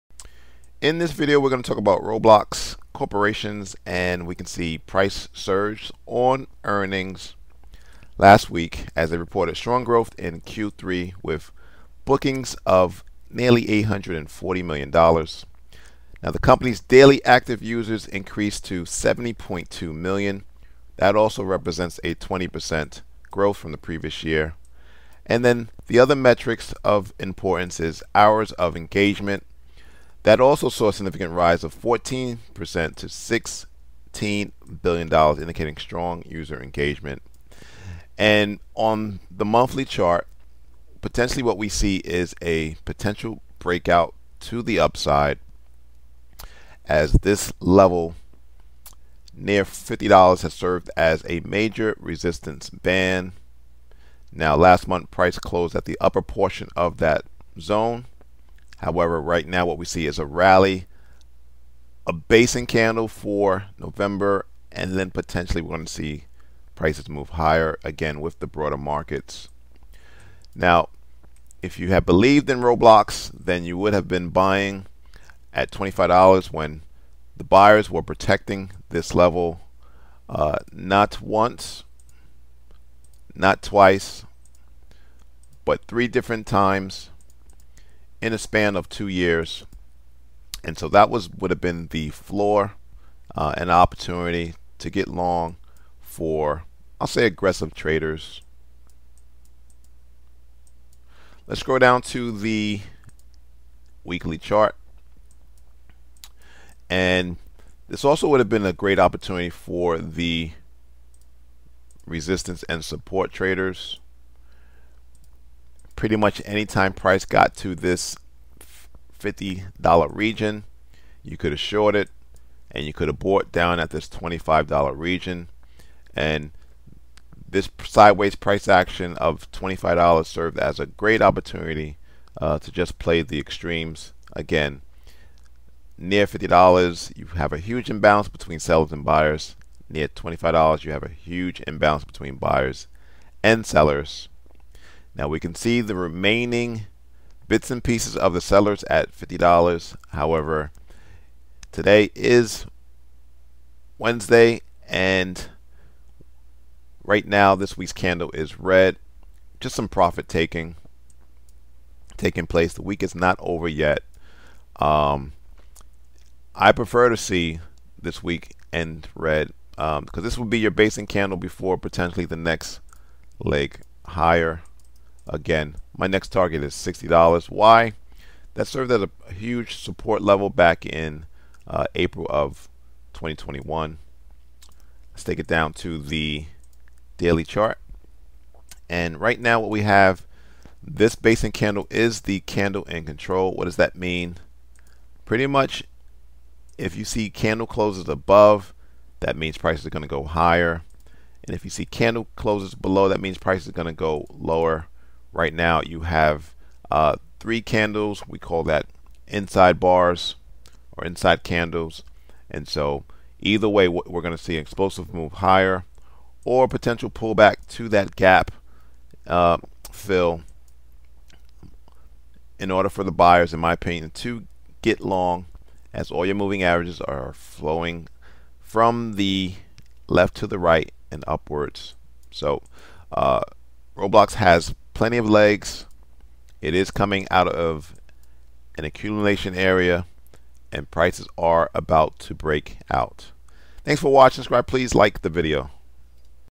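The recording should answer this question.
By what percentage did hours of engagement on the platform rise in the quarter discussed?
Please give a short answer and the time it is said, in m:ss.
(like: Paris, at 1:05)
14%, at 0:31.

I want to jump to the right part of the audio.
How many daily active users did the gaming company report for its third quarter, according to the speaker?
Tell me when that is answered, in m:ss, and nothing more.
0:18.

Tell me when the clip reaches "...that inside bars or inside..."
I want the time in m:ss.
3:28.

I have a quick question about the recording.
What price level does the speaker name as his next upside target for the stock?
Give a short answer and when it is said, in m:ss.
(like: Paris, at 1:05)
$60, at 2:56.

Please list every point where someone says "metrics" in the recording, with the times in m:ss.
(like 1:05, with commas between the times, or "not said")
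0:26.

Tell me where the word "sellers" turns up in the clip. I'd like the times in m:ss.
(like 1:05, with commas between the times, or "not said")
2:18, 2:23, 2:28.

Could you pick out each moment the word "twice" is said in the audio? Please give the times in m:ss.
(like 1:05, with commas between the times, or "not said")
1:23.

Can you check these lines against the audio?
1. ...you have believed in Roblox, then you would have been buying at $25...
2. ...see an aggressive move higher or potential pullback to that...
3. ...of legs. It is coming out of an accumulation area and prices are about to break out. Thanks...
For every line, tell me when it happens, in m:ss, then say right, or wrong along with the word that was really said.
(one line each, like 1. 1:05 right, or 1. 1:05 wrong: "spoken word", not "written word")
1. 1:11 right
2. 3:34 wrong: "explosive", not "aggressive"
3. 3:55 right.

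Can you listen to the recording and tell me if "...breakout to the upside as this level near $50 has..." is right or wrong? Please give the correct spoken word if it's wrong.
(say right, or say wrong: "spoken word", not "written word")
right.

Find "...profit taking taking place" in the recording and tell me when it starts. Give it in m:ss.
2:39.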